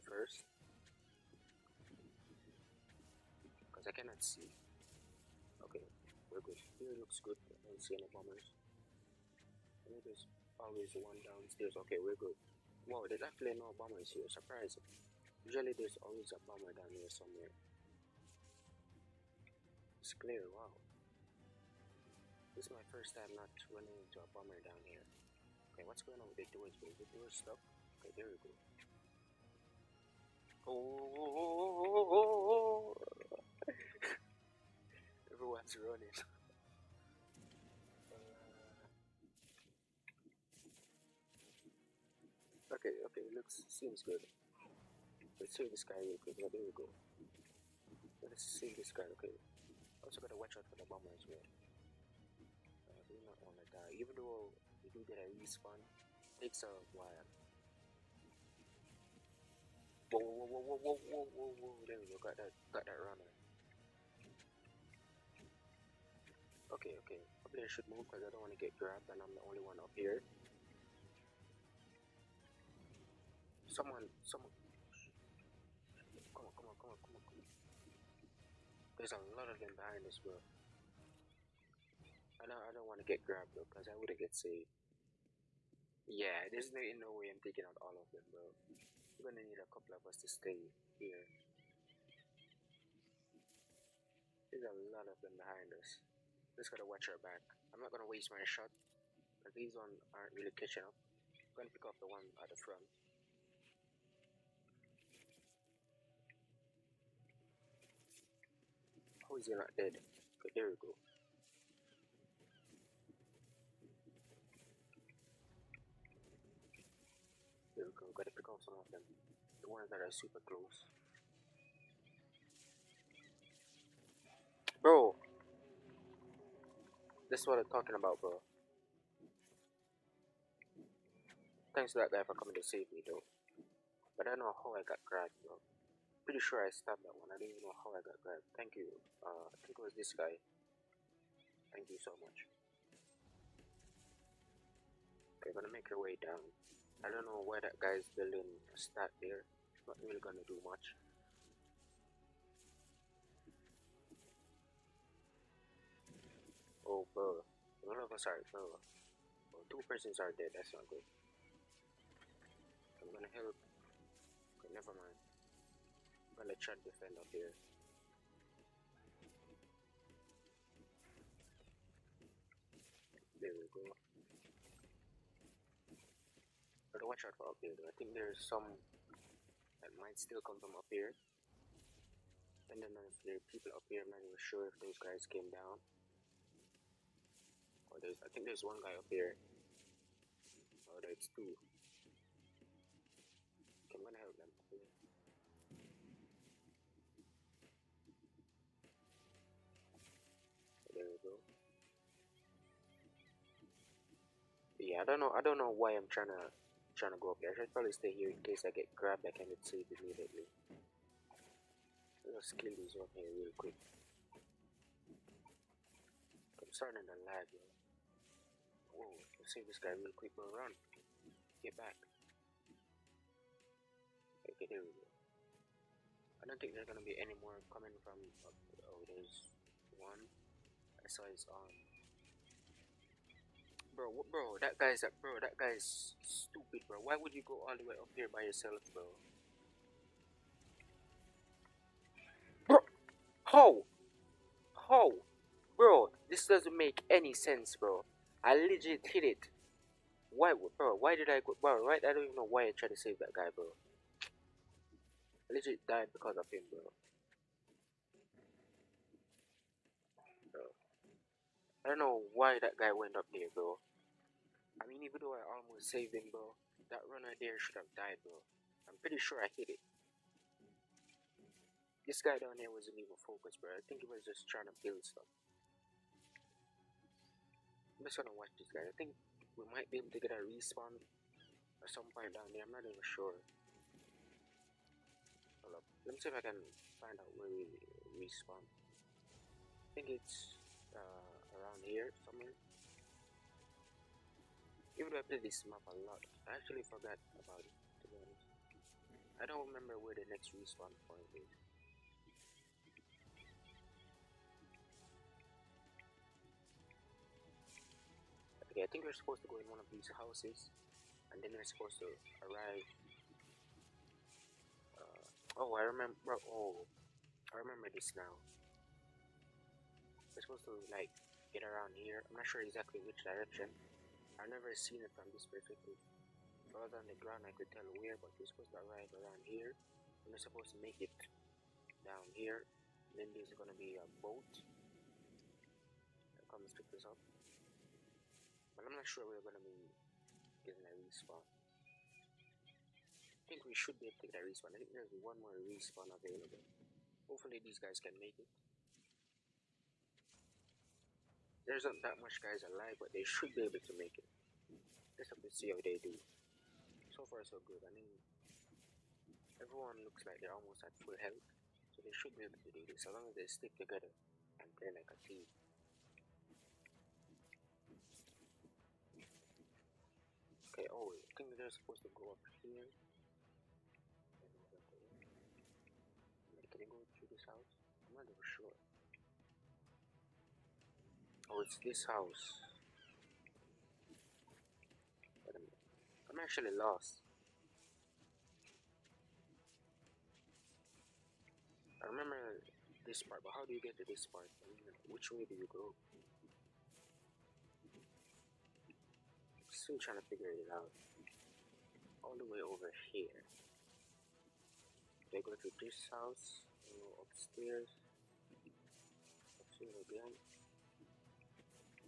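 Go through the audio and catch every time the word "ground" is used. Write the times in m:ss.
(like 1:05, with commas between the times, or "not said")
5:27.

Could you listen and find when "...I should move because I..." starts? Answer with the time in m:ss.
1:07.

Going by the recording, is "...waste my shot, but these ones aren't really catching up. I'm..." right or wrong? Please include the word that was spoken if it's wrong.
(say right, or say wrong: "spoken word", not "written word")
right.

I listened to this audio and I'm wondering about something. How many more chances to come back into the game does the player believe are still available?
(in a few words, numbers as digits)
1.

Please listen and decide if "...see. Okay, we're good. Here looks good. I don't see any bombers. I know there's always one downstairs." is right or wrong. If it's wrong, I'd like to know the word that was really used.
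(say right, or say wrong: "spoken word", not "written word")
right.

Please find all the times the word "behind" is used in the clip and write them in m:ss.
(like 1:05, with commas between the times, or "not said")
1:19, 1:35.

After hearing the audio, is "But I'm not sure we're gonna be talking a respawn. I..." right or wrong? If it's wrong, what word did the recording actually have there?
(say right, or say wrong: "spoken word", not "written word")
wrong: "getting", not "talking".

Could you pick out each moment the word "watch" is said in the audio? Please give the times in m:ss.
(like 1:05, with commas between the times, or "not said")
0:50, 1:36, 2:57, 4:38.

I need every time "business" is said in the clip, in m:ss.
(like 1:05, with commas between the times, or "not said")
not said.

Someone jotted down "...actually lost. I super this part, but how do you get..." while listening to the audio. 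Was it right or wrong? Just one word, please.
wrong.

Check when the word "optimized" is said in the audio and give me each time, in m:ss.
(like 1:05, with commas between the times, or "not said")
not said.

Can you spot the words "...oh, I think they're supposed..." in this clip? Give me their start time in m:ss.
6:10.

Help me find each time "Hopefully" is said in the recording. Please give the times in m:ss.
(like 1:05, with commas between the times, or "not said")
5:47.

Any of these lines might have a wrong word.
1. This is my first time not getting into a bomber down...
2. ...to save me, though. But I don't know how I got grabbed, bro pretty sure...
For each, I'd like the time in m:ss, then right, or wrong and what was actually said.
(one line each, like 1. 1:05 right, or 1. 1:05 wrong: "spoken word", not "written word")
1. 0:22 wrong: "running", not "getting"
2. 2:12 right.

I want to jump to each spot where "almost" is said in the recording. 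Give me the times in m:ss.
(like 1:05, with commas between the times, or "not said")
4:25, 6:00.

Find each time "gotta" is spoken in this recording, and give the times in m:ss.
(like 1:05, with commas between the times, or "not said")
0:50, 1:36, 1:58.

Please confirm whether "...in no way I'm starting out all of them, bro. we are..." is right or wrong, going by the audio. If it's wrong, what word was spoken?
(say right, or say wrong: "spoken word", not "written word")
wrong: "taking", not "starting".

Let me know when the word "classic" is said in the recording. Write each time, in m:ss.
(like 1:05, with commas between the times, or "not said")
not said.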